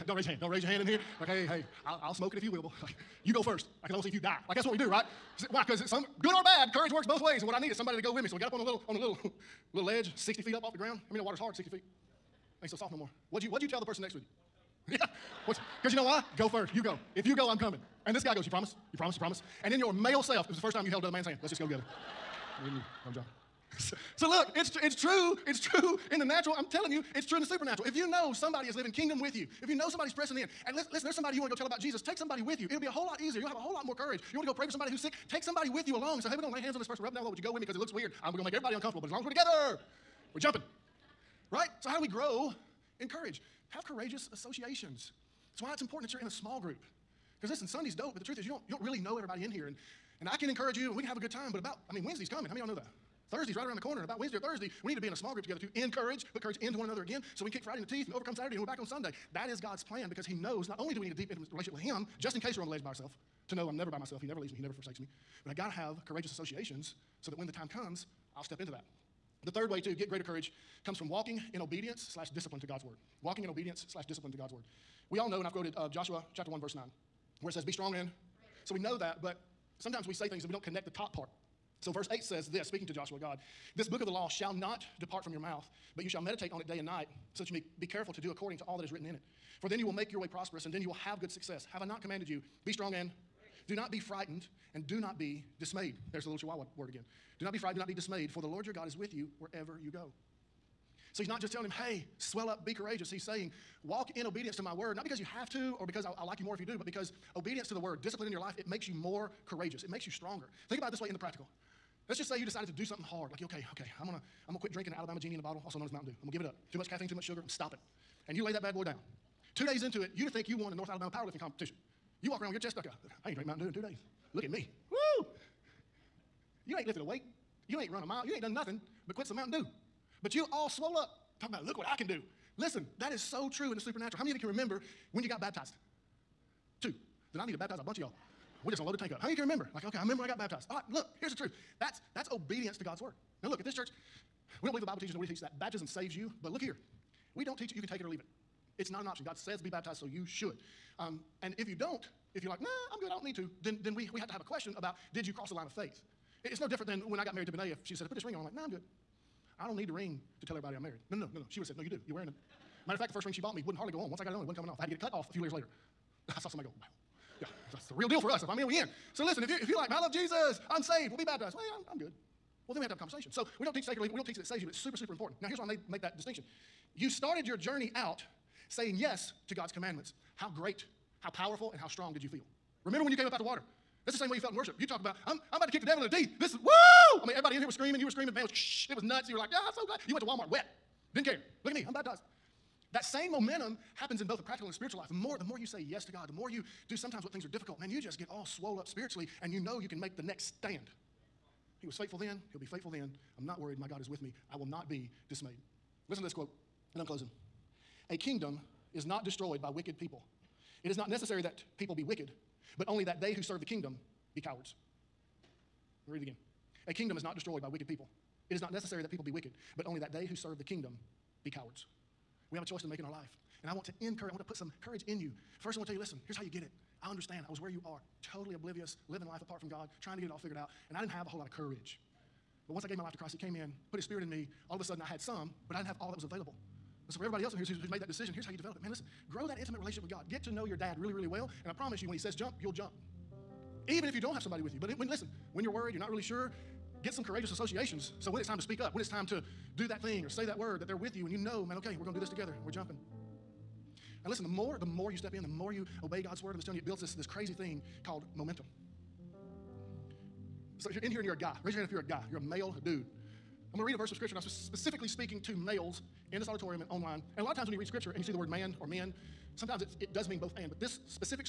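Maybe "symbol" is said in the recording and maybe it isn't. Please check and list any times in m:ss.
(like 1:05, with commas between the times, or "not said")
not said.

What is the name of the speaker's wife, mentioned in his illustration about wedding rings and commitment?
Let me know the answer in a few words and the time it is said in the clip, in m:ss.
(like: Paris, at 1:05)
Benay, at 2:37.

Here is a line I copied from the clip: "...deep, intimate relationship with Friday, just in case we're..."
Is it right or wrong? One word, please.
wrong.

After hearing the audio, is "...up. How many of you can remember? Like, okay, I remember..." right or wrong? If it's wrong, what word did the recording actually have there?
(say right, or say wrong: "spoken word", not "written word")
right.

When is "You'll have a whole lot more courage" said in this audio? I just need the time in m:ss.
0:33.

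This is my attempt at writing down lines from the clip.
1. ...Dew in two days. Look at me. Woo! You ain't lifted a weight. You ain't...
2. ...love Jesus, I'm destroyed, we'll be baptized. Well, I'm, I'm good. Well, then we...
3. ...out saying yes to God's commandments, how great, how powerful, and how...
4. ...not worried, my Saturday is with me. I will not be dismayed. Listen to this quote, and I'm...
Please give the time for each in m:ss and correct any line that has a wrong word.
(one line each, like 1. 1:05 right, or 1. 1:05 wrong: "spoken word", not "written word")
1. 2:03 right
2. 2:49 wrong: "saved", not "destroyed"
3. 2:57 right
4. 3:23 wrong: "God", not "Saturday".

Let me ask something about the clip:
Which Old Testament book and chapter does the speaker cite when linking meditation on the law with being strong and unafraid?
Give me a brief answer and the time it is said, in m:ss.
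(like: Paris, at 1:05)
Joshua chapter 1, at 1:15.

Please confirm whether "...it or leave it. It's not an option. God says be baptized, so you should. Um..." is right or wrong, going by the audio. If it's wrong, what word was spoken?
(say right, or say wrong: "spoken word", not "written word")
right.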